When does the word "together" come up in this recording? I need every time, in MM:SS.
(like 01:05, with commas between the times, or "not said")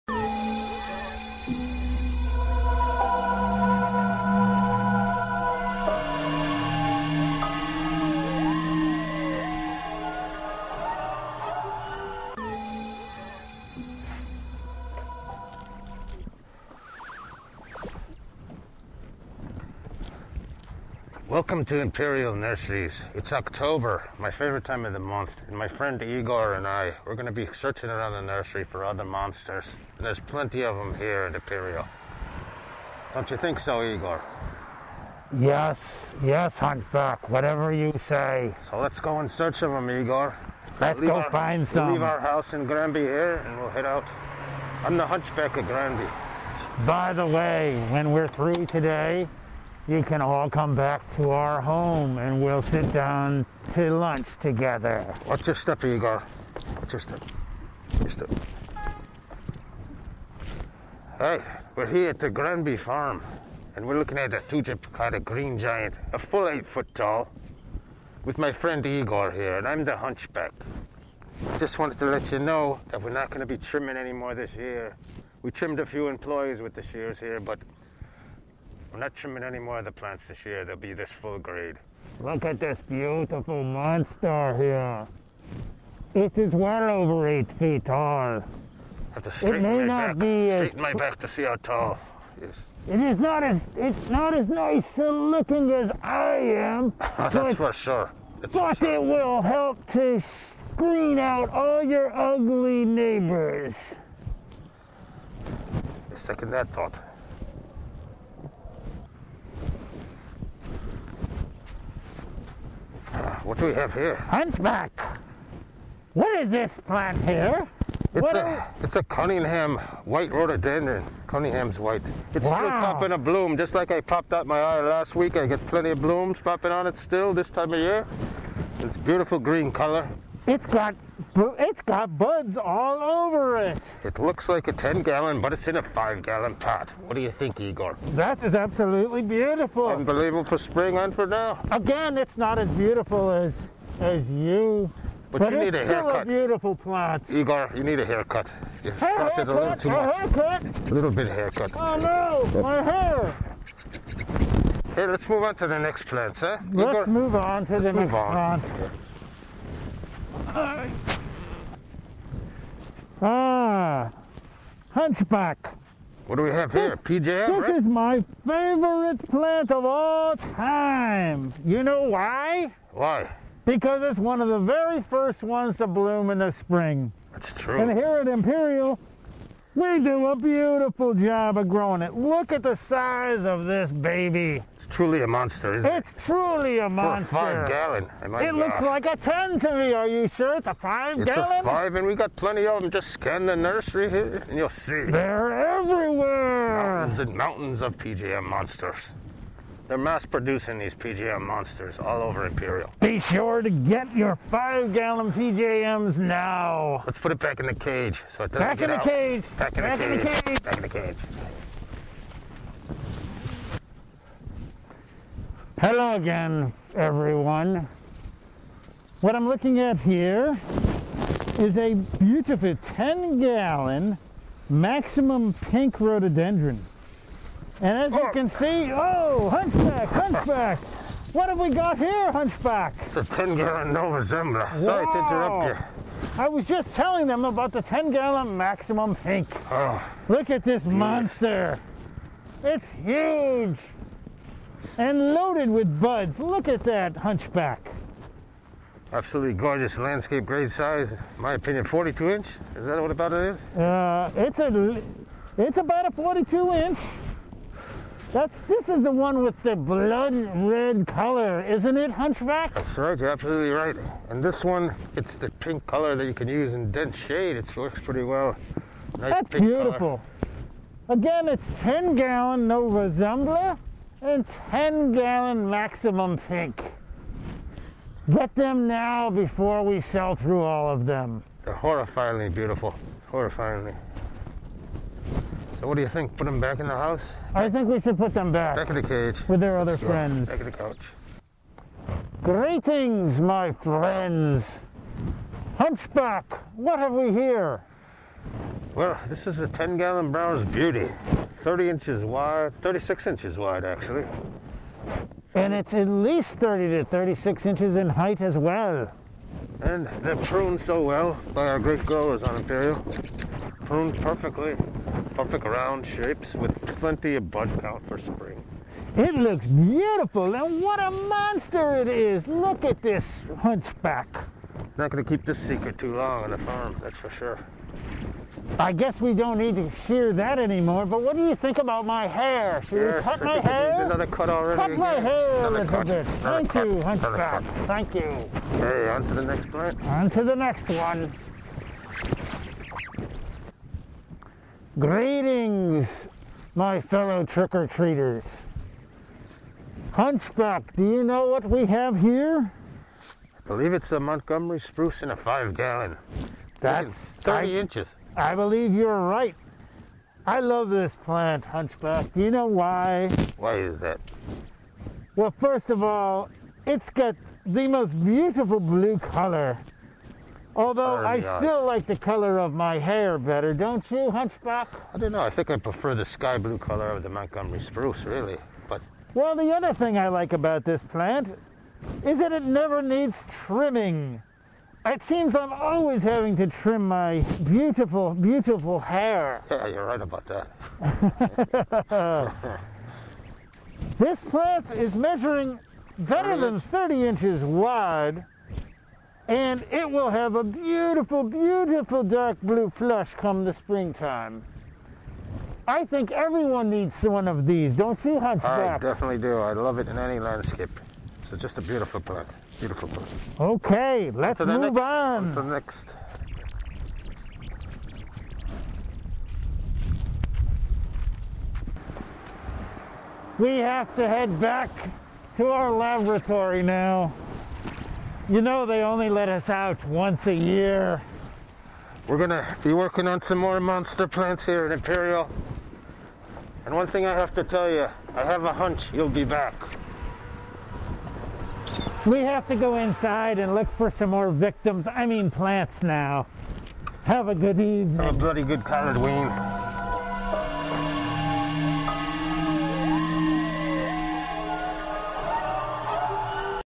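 00:54.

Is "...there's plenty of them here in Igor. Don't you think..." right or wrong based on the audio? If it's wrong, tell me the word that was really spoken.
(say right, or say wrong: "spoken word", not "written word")
wrong: "Imperial", not "Igor".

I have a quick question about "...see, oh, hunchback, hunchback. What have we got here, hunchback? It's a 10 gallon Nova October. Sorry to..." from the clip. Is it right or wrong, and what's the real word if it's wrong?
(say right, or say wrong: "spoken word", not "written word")
wrong: "Zembla", not "October".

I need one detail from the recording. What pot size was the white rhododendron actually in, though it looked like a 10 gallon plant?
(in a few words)
5 gallon.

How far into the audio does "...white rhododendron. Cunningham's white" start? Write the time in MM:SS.
02:00.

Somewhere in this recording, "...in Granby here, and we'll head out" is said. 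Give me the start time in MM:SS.
00:42.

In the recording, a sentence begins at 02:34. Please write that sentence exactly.
Hey, let's move on to the next plant, huh?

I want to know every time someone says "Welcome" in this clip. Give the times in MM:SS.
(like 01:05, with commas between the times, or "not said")
00:21.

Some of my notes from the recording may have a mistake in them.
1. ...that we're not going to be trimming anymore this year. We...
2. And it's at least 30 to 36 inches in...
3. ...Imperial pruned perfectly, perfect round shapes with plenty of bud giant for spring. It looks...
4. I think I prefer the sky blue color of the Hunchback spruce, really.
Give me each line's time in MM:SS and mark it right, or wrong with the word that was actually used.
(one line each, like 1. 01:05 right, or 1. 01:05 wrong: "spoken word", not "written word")
1. 01:12 right
2. 05:05 right
3. 05:12 wrong: "count", not "giant"
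4. 06:15 wrong: "Montgomery", not "Hunchback".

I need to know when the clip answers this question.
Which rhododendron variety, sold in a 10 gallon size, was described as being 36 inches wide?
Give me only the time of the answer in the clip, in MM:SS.
05:00.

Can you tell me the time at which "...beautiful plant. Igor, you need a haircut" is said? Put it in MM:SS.
02:26.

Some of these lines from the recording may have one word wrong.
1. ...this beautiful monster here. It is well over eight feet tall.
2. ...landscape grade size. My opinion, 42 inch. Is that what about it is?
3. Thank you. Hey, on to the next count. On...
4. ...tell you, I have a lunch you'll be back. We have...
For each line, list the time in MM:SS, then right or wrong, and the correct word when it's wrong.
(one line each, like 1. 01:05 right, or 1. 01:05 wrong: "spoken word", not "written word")
1. 01:22 right
2. 04:09 right
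3. 05:37 wrong: "plant", not "count"
4. 07:17 wrong: "hunch", not "lunch".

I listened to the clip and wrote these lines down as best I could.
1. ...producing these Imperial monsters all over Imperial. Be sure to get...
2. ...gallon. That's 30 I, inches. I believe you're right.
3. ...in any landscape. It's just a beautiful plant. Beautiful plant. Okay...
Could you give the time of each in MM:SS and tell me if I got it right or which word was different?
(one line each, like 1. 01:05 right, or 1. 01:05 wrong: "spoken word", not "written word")
1. 03:20 wrong: "PJM", not "Imperial"
2. 05:55 right
3. 06:50 right.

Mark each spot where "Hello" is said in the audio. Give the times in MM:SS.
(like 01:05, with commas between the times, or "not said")
03:35.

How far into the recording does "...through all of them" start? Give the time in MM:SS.
04:40.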